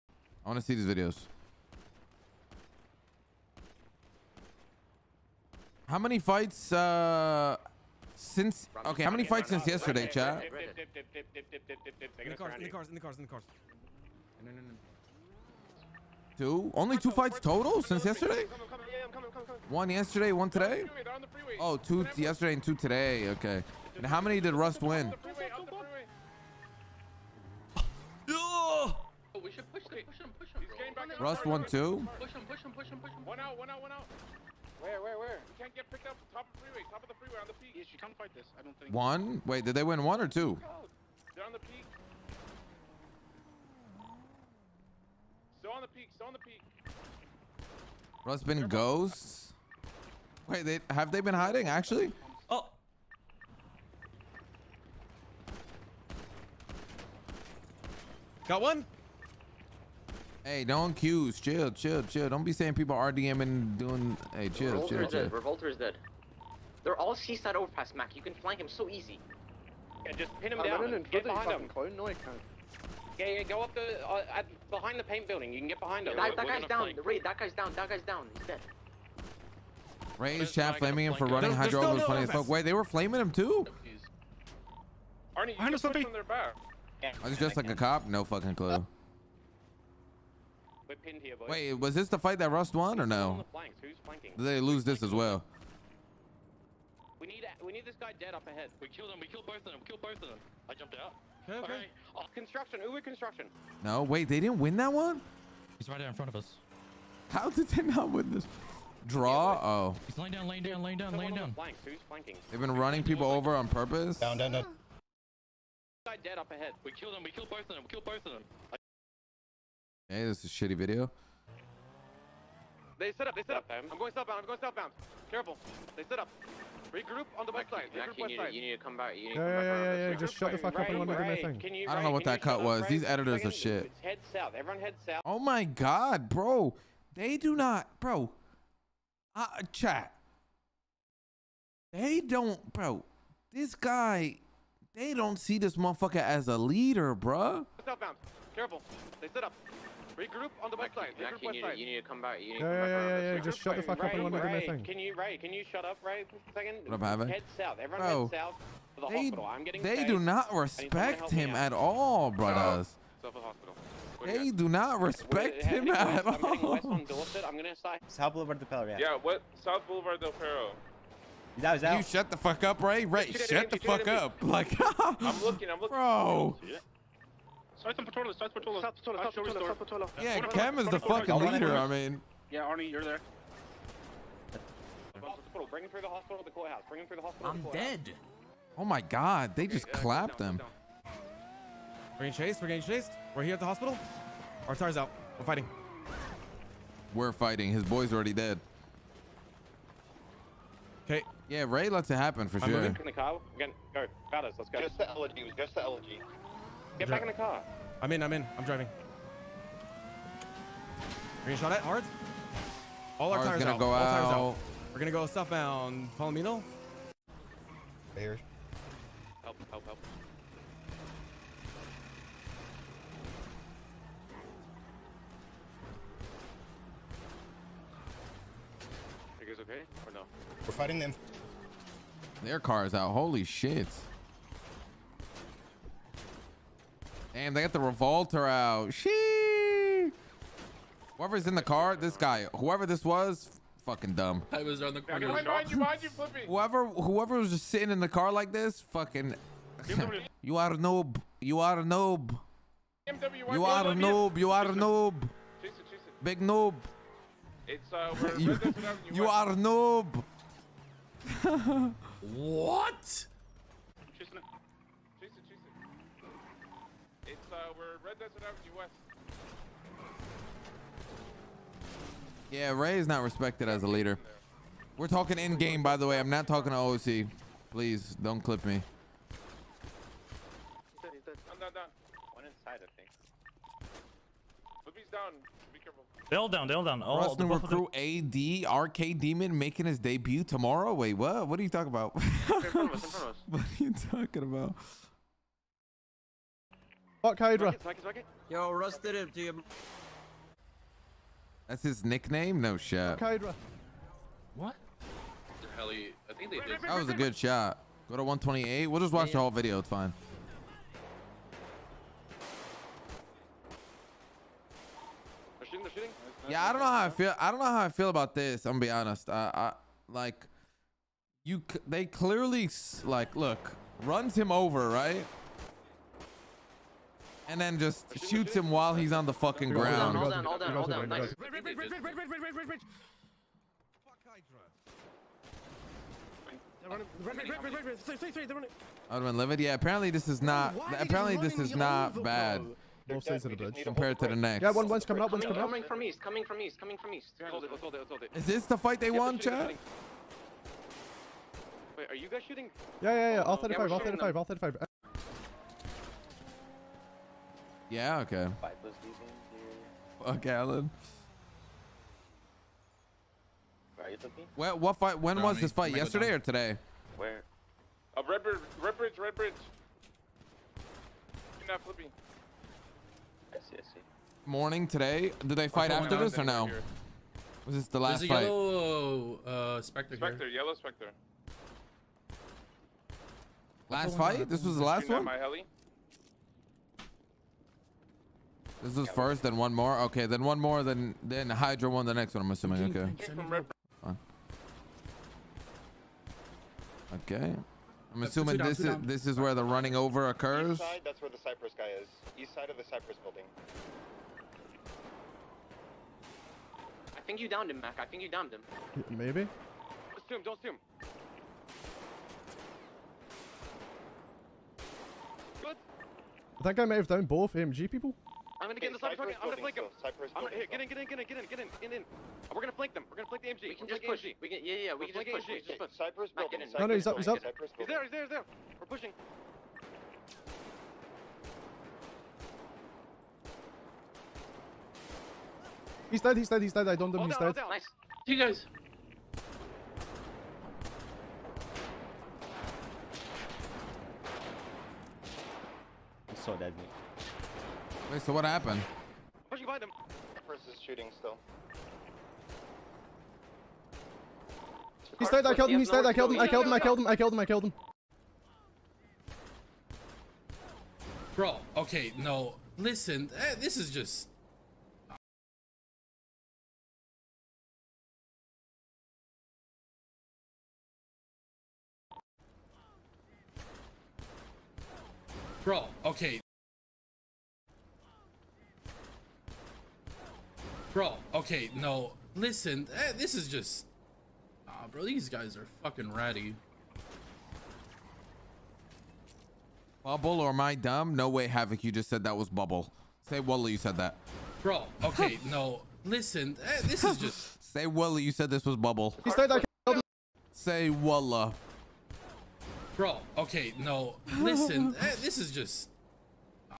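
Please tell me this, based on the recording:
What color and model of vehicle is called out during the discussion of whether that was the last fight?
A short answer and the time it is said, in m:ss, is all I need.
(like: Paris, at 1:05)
Yellow Spectre, at 6:20.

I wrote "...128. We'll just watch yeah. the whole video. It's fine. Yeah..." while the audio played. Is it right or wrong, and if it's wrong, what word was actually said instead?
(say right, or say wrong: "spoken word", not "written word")
right.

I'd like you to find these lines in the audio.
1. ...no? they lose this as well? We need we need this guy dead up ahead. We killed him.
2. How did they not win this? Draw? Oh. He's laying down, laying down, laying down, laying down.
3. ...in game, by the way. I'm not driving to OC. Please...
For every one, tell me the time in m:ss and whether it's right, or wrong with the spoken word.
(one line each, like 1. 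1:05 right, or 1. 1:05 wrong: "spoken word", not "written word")
1. 1:33 right
2. 1:47 right
3. 4:35 wrong: "talking", not "driving".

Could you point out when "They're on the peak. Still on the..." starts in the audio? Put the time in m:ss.
0:41.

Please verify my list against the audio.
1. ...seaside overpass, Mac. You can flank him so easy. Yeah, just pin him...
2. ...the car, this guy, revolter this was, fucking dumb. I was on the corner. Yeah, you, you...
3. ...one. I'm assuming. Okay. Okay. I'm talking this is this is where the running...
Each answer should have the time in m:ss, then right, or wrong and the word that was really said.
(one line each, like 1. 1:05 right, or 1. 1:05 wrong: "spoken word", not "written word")
1. 1:07 right
2. 4:01 wrong: "whoever", not "revolter"
3. 6:32 wrong: "assuming", not "talking".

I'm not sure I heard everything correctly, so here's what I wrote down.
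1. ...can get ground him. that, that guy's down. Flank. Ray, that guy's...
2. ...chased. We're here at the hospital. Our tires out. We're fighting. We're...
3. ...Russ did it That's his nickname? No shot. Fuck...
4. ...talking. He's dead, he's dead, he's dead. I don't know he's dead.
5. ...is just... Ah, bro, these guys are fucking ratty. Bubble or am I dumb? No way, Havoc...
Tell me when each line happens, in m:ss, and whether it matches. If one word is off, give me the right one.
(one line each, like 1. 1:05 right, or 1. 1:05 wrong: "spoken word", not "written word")
1. 1:15 wrong: "behind", not "ground"
2. 3:12 right
3. 4:58 right
4. 7:08 wrong: "pushing", not "talking"
5. 8:03 right.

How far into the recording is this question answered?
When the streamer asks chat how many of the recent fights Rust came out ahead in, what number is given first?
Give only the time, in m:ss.
0:31.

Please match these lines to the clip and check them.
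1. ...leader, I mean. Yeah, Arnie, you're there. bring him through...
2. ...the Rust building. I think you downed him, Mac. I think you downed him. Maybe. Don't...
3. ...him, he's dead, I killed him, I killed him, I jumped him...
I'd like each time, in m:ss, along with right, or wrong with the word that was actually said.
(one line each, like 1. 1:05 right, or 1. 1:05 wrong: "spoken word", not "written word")
1. 3:01 right
2. 6:42 wrong: "Cypress", not "Rust"
3. 7:35 wrong: "killed", not "jumped".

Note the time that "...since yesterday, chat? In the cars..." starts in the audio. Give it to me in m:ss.
0:09.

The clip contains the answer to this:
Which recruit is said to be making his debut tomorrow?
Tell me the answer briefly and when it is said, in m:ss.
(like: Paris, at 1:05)
AD RK Demon, at 4:47.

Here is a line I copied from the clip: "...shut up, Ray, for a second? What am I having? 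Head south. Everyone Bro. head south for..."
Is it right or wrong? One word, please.
right.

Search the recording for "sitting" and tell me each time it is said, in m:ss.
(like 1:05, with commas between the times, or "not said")
4:07.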